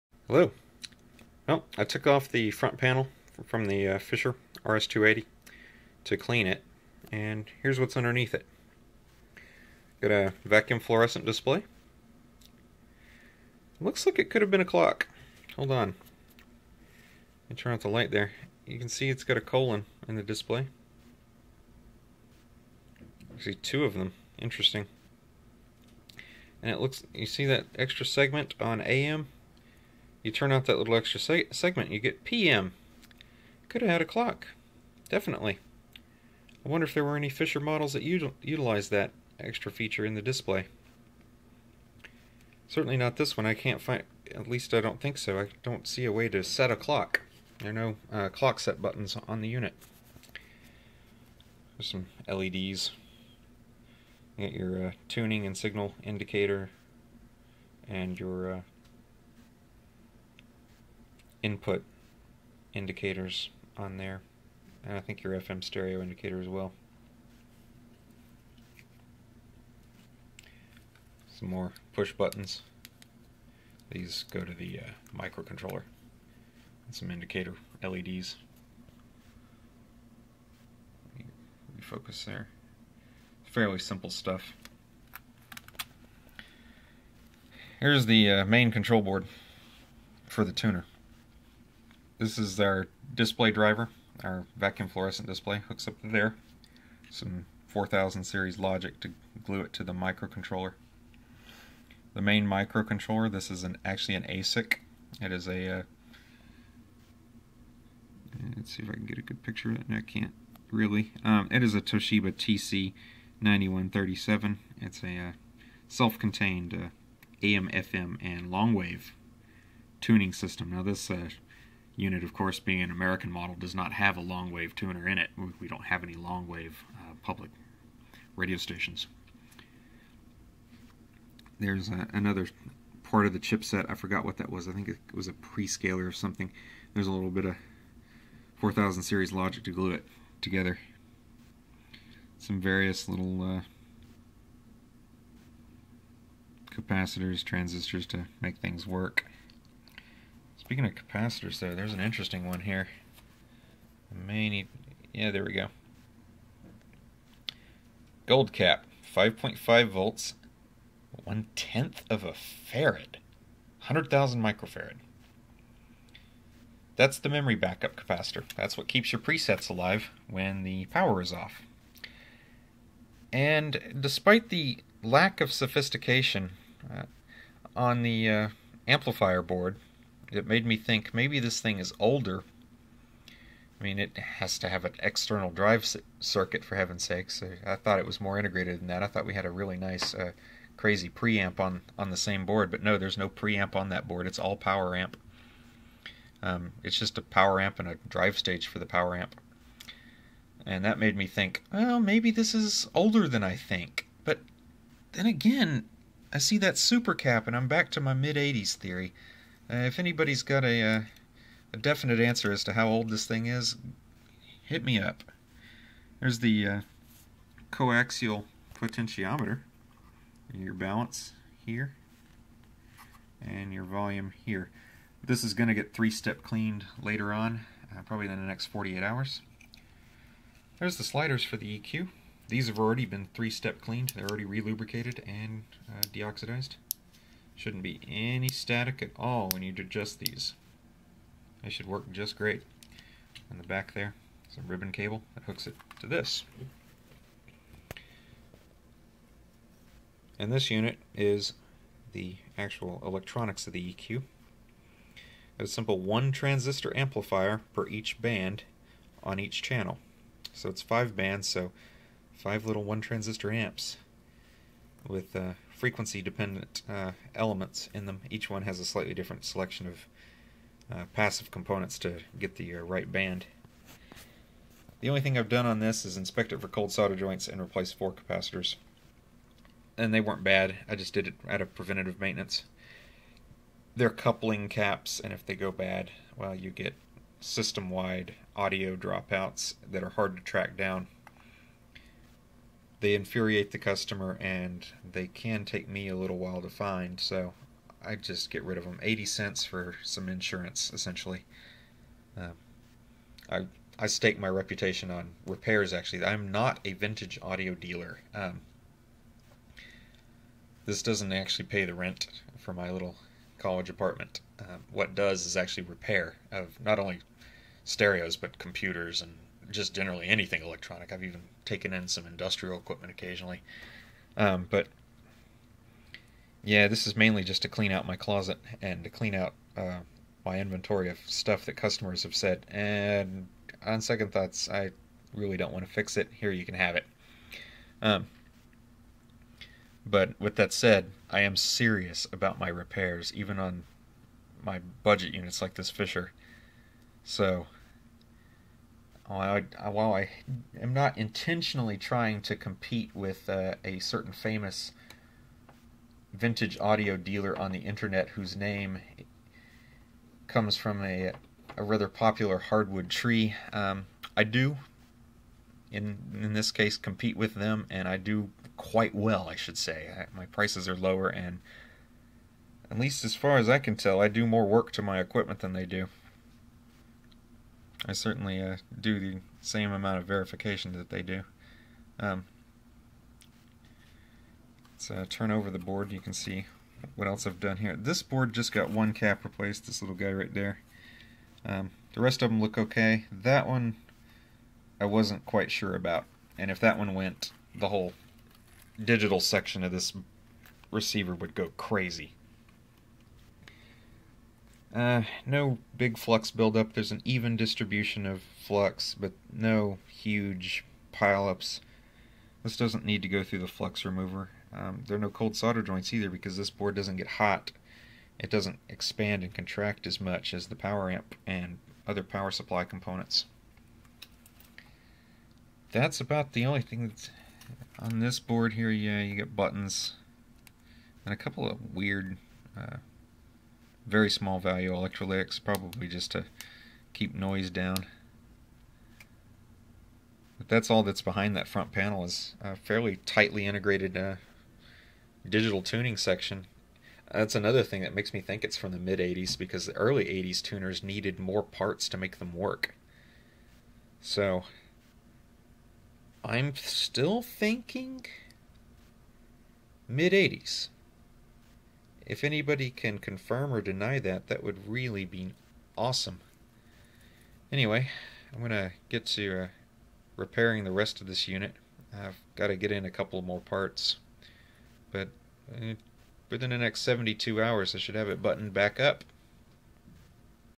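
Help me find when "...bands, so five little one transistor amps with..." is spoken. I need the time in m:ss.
4:21.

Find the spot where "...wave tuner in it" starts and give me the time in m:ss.
2:04.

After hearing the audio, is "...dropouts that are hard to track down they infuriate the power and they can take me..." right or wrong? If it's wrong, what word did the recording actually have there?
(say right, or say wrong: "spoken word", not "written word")
wrong: "customer", not "power".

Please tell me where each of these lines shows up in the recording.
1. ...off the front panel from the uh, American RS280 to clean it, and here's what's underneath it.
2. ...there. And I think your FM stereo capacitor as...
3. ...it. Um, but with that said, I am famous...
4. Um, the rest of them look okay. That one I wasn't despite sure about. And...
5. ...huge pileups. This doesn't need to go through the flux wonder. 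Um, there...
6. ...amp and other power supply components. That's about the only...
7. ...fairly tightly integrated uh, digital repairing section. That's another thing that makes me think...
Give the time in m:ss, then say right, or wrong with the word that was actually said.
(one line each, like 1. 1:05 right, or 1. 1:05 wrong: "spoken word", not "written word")
1. 0:02 wrong: "Fisher", not "American"
2. 1:03 wrong: "indicator", not "capacitor"
3. 5:36 wrong: "serious", not "famous"
4. 6:31 wrong: "quite", not "despite"
5. 6:50 wrong: "remover", not "wonder"
6. 7:01 right
7. 7:22 wrong: "tuning", not "repairing".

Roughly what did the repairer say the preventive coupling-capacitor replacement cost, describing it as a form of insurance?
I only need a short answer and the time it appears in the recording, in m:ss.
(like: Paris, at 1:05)
80 cents, at 4:59.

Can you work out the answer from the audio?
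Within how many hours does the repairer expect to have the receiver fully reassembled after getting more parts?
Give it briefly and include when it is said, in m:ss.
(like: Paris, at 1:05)
72, at 7:57.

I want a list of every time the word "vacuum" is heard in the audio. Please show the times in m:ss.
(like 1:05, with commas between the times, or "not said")
0:10, 1:34.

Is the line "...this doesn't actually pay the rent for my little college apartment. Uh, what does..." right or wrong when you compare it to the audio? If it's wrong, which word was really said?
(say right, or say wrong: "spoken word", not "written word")
right.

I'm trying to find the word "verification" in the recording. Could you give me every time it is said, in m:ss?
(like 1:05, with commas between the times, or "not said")
6:20.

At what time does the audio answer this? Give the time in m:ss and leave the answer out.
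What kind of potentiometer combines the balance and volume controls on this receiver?
3:37.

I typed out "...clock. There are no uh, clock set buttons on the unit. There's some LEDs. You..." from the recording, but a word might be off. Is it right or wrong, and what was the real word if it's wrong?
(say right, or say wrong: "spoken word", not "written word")
right.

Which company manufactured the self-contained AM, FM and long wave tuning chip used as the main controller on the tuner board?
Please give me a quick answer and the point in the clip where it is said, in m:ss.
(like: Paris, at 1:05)
Toshiba, at 1:51.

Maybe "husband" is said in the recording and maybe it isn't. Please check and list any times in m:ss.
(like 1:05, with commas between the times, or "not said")
not said.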